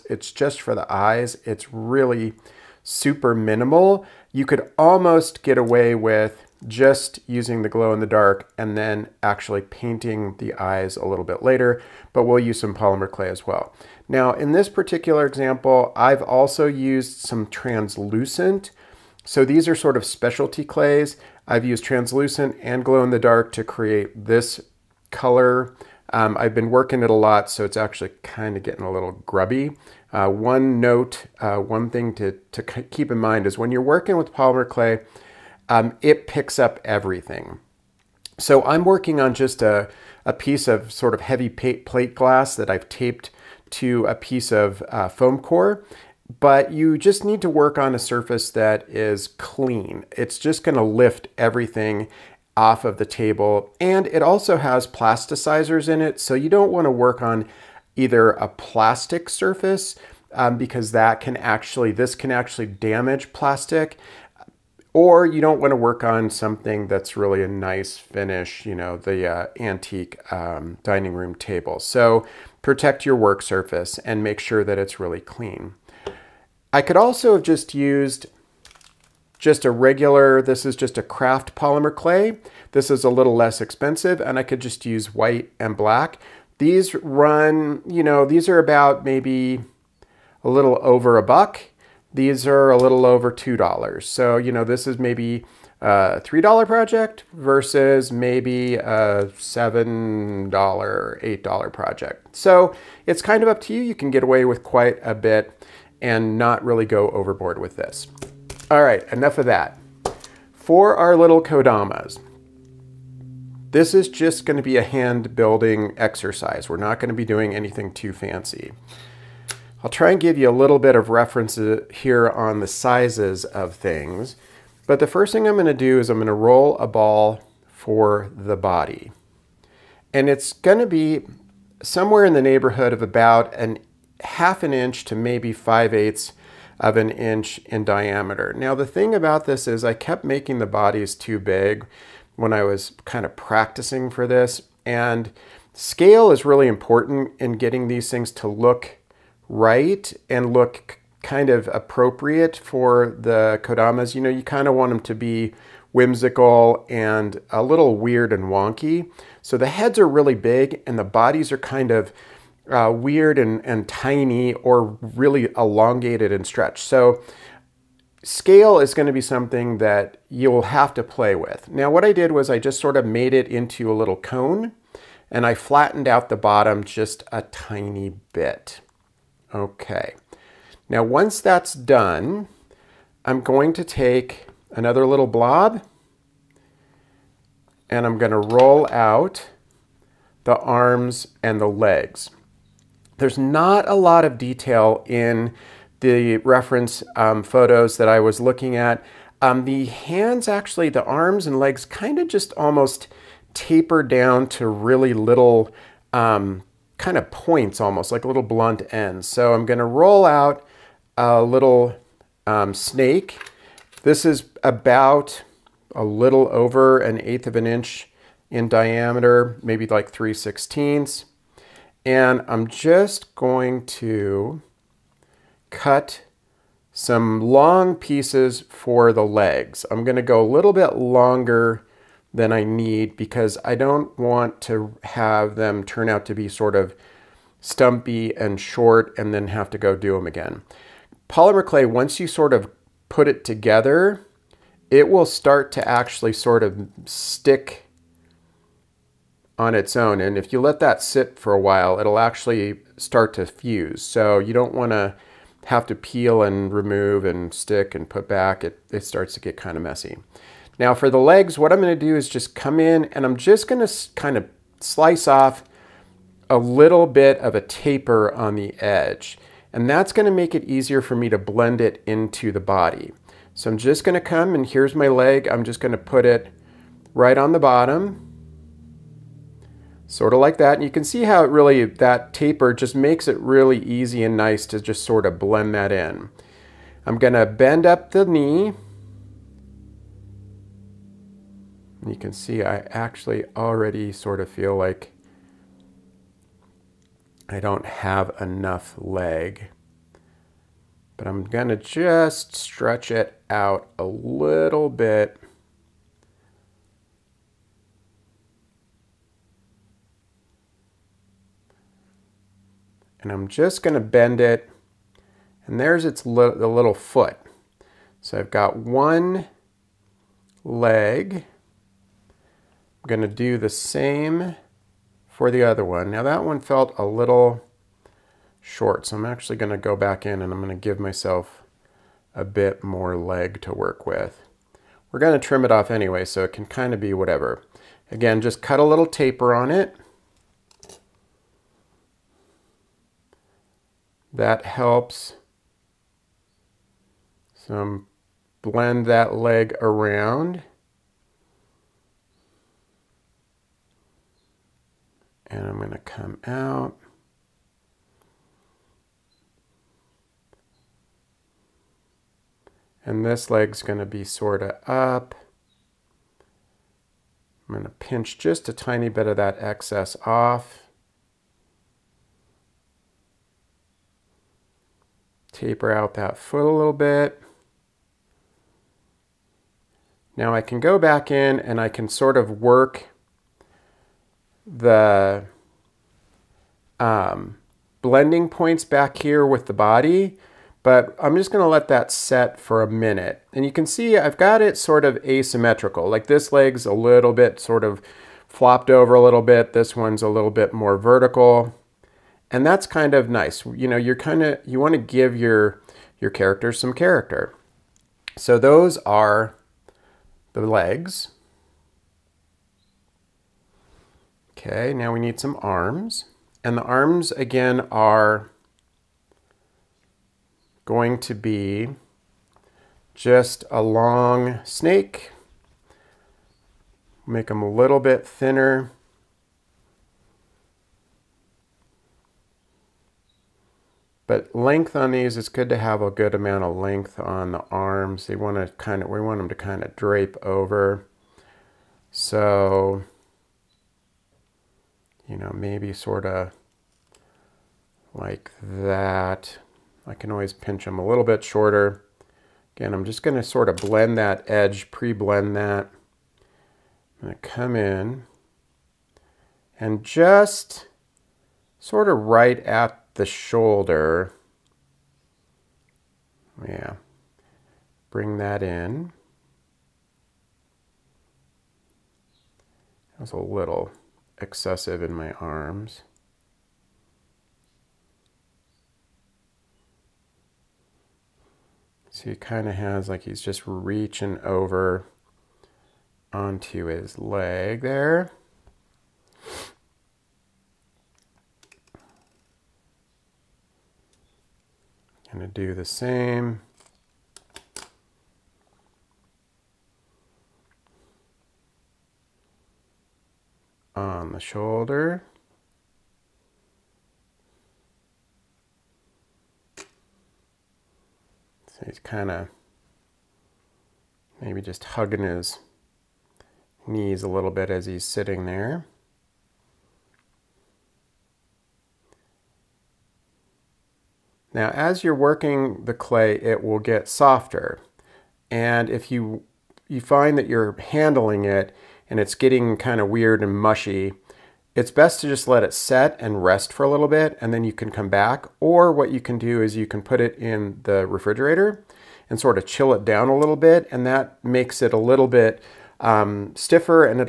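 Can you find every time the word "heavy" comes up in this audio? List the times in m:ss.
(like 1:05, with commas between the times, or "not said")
0:41.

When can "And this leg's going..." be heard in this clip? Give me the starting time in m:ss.
6:03.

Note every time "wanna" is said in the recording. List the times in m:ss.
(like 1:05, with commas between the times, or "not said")
0:56, 6:44.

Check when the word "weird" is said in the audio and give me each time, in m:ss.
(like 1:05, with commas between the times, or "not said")
2:37, 2:42, 8:53.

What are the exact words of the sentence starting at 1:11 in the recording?
So protect your work surface and make sure that it's really clean.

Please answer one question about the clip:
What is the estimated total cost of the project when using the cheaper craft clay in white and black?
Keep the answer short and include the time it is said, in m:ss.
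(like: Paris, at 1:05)
$3, at 1:36.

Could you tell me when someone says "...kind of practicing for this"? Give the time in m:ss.
2:23.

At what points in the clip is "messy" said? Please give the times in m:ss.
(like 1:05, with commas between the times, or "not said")
4:19.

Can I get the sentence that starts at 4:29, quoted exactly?
And that's gonna make it easier for me to blend it into the body.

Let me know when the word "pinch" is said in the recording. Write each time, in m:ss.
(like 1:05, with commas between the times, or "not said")
6:07, 7:30.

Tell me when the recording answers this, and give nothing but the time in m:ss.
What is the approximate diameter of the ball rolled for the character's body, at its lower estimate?
2:14.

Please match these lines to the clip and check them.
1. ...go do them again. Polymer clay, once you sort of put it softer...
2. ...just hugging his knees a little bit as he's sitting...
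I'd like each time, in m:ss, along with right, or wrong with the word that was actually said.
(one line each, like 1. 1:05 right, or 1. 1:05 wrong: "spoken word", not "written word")
1. 3:59 wrong: "together", not "softer"
2. 8:34 right.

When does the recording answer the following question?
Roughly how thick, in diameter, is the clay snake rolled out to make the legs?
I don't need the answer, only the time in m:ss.
3:40.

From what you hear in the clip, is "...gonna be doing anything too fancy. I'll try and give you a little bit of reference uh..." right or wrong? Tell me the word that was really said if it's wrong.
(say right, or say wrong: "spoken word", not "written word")
right.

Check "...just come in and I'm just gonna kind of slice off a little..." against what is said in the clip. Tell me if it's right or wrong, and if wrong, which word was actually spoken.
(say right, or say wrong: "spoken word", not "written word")
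right.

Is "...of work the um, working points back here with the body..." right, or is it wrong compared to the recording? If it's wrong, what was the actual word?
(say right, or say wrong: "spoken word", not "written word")
wrong: "blending", not "working".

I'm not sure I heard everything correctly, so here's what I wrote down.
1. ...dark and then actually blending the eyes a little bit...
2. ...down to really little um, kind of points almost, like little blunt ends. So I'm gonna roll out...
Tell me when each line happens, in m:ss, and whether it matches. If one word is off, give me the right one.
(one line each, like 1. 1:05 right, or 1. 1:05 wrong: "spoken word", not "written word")
1. 0:08 wrong: "painting", not "blending"
2. 3:24 right.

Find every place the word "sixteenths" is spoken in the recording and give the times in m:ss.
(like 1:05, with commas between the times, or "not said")
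3:40.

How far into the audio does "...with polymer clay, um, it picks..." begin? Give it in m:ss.
0:34.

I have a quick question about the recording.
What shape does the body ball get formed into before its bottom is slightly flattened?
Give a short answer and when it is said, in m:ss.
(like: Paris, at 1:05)
cone, at 2:53.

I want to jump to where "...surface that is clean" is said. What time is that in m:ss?
0:47.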